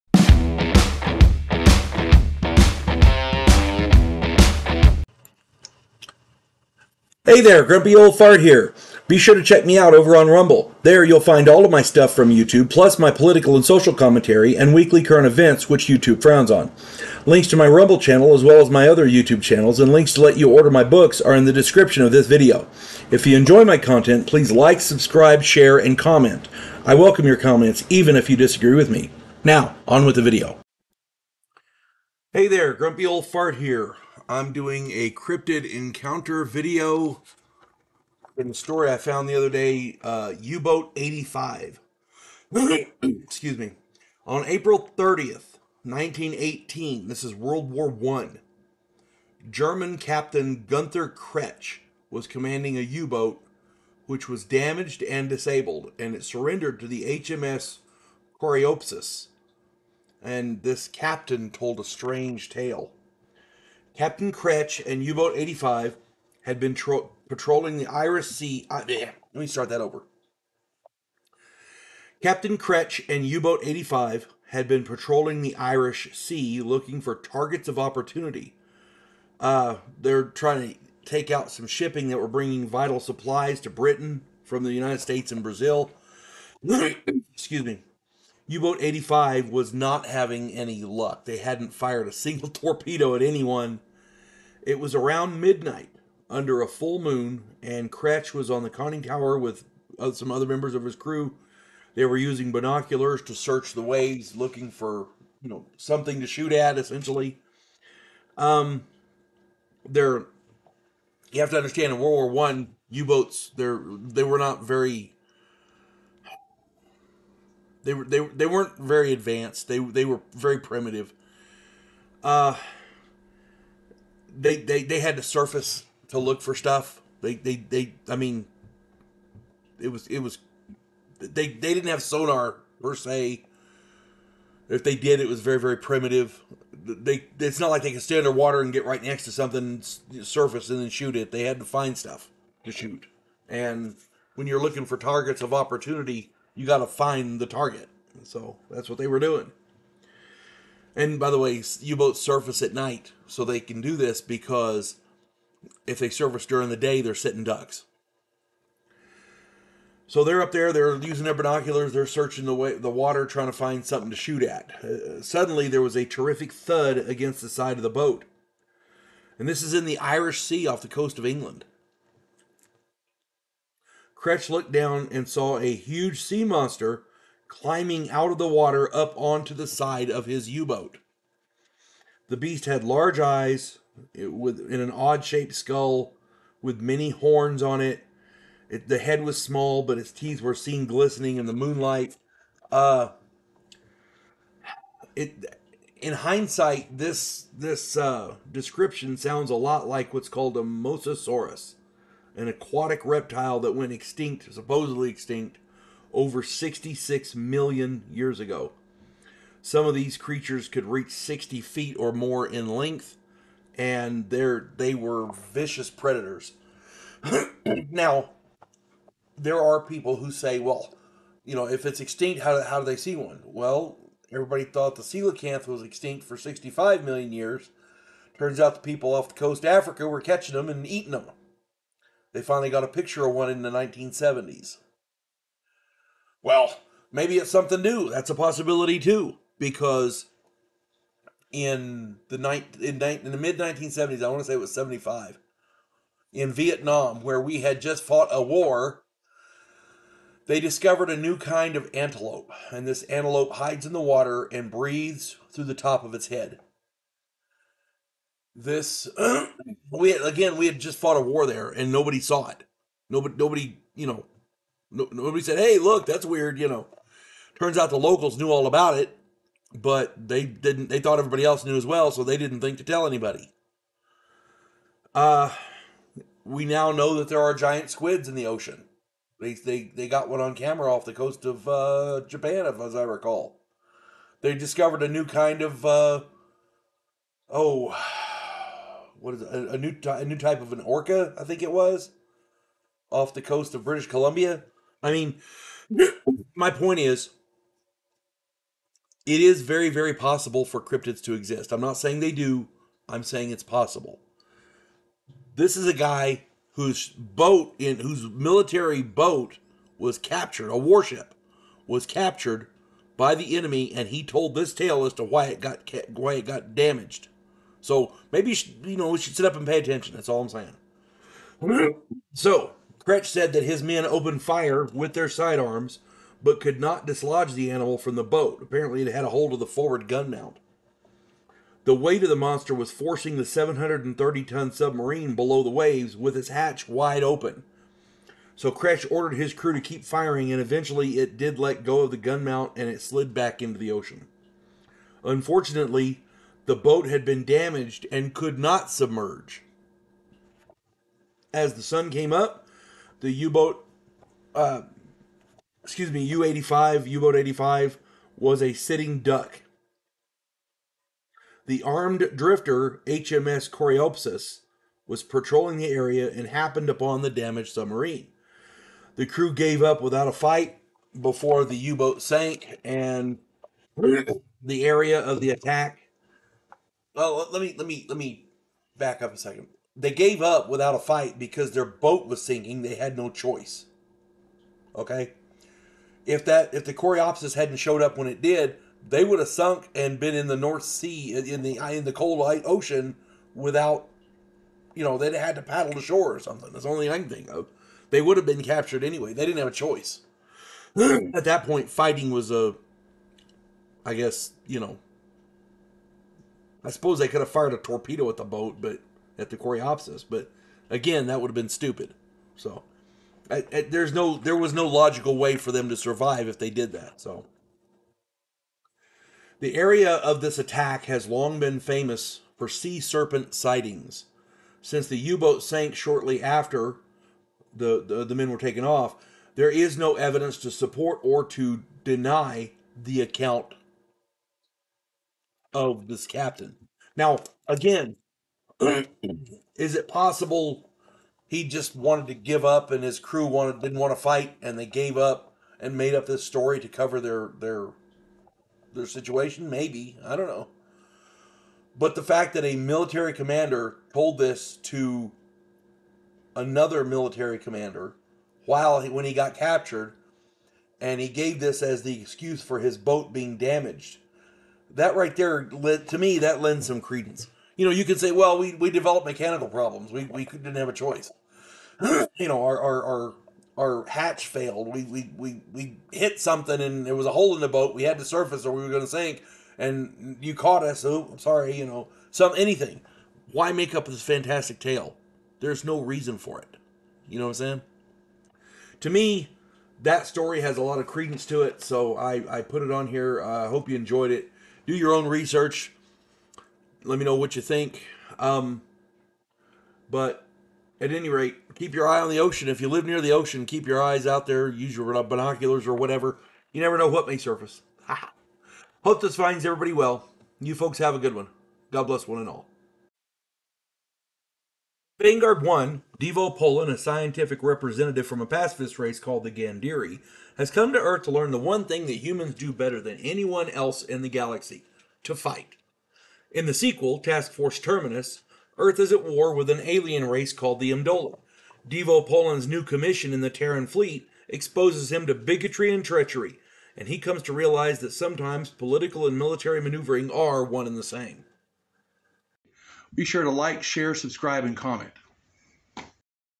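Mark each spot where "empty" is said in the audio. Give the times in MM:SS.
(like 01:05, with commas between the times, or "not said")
not said.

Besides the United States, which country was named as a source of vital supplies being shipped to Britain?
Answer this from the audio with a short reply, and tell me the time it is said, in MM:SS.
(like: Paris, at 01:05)
Brazil, at 01:25.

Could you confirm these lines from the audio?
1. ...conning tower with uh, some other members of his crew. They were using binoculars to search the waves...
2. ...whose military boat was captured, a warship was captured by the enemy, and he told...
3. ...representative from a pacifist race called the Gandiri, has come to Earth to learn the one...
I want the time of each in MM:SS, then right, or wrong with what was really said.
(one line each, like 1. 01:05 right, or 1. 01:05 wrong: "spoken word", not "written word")
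1. 01:38 right
2. 05:07 right
3. 08:37 right.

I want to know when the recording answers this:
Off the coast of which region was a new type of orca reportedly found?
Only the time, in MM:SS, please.
04:53.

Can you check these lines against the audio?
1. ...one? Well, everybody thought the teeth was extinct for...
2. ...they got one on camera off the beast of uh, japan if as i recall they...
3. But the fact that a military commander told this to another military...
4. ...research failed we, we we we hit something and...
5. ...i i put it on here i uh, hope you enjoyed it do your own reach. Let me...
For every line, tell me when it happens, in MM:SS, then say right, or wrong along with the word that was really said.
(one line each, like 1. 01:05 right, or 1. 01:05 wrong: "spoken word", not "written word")
1. 03:43 wrong: "coelacanth", not "teeth"
2. 04:39 wrong: "coast", not "beast"
3. 07:31 right
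4. 07:54 wrong: "hatch", not "research"
5. 08:12 wrong: "research", not "reach".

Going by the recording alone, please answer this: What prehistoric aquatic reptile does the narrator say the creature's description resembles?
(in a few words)
mosasaurus.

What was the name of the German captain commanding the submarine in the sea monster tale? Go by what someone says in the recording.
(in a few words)
Gunther Kretsch.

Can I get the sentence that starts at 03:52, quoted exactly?
They finally got a picture of one in the 1970s.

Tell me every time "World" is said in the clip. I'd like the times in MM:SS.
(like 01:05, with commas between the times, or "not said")
00:47, 01:51.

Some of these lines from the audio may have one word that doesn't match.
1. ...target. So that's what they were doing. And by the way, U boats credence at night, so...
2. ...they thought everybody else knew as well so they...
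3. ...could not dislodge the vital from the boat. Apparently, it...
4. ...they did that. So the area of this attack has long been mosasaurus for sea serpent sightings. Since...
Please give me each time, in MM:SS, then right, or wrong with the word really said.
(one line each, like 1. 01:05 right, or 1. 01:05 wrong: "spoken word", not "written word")
1. 02:27 wrong: "surface", not "credence"
2. 04:30 right
3. 05:26 wrong: "animal", not "vital"
4. 06:56 wrong: "famous", not "mosasaurus".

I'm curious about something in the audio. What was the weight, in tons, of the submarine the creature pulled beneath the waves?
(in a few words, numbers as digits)
730.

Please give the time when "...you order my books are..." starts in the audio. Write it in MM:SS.
00:20.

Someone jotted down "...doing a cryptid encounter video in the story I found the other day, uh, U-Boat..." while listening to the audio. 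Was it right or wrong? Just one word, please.
right.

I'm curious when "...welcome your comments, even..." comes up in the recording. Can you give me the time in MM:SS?
00:26.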